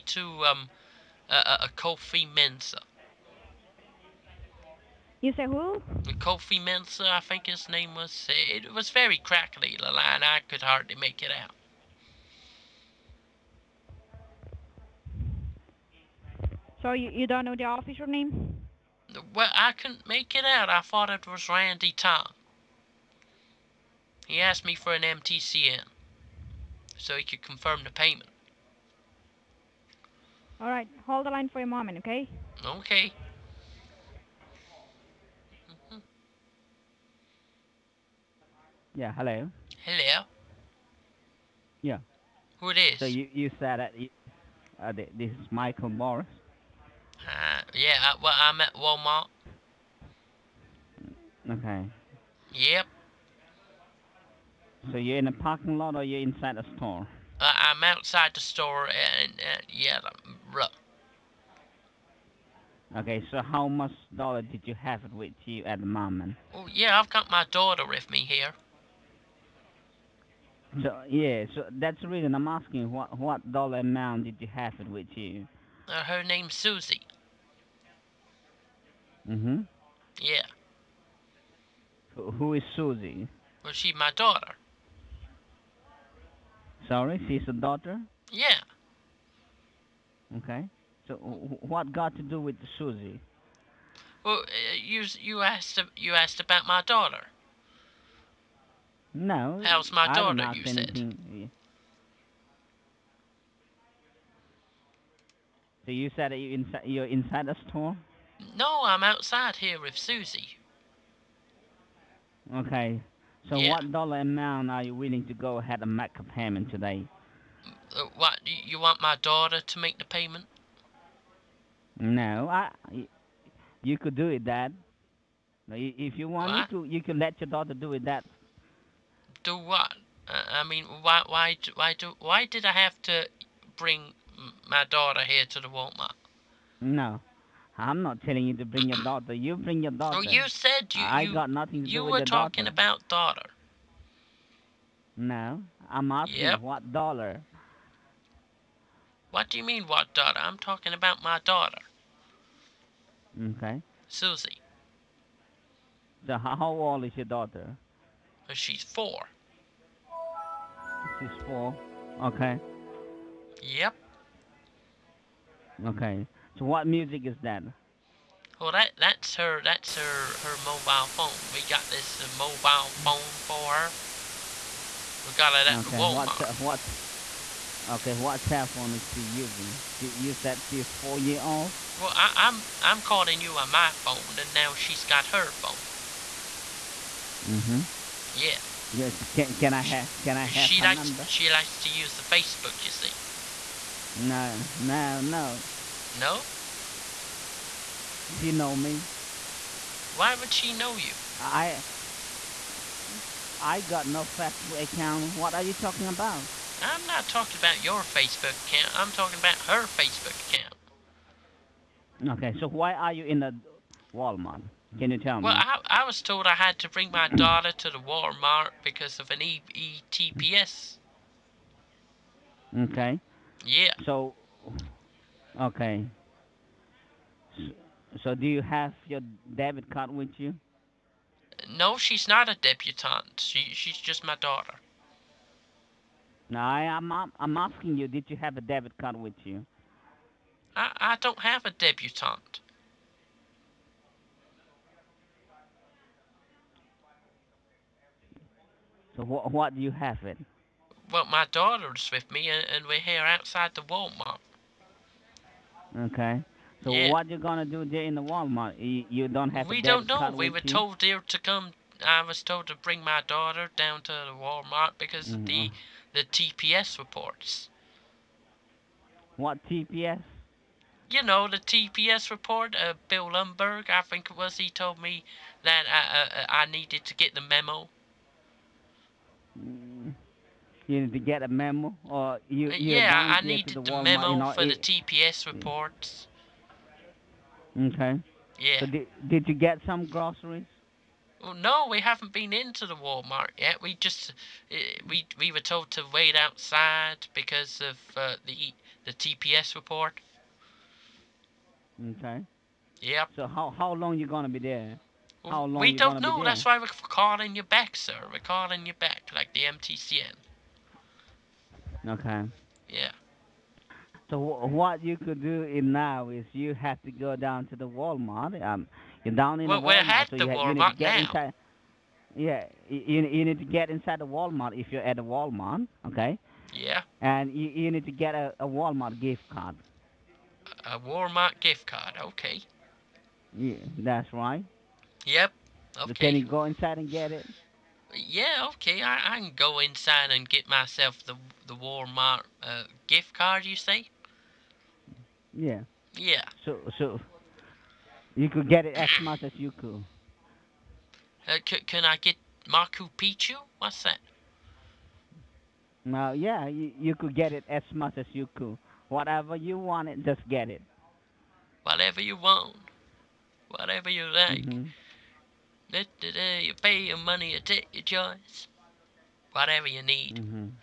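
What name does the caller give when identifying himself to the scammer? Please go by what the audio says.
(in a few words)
Michael Morris.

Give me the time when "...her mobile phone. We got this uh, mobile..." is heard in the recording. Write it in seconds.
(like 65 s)
170 s.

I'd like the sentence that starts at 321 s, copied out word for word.
Inside, yeah, you, you need to get inside the Walmart if you're at the Walmart, okay?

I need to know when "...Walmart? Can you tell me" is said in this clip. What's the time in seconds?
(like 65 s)
214 s.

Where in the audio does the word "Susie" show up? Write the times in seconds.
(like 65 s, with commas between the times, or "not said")
76 s, 82 s, 92 s, 109 s, 154 s.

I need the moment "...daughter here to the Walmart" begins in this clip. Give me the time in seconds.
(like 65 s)
134 s.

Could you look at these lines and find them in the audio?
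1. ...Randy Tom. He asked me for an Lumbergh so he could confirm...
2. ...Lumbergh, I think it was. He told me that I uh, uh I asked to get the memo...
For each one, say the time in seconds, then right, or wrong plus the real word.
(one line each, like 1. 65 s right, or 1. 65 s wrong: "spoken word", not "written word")
1. 21 s wrong: "MTCN", not "Lumbergh"
2. 273 s wrong: "needed", not "asked".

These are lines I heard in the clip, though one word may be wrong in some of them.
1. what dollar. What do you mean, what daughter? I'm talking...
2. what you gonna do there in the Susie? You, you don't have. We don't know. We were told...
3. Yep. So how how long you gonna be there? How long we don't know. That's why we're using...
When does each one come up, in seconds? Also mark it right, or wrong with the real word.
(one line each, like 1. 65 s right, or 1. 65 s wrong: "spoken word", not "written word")
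1. 146 s right
2. 257 s wrong: "Walmart", not "Susie"
3. 303 s wrong: "calling", not "using".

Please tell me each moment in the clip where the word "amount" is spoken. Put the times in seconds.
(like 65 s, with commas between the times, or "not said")
73 s, 114 s.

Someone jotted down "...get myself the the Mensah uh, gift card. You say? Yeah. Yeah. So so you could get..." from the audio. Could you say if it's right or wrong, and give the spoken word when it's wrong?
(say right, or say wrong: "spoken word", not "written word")
wrong: "Walmart", not "Mensah".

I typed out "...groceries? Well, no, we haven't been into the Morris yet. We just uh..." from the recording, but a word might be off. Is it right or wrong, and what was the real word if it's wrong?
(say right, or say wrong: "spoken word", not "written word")
wrong: "Walmart", not "Morris".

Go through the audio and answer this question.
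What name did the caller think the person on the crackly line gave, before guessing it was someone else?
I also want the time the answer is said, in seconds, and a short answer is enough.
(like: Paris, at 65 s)
Kofi Mensah, at 6 s.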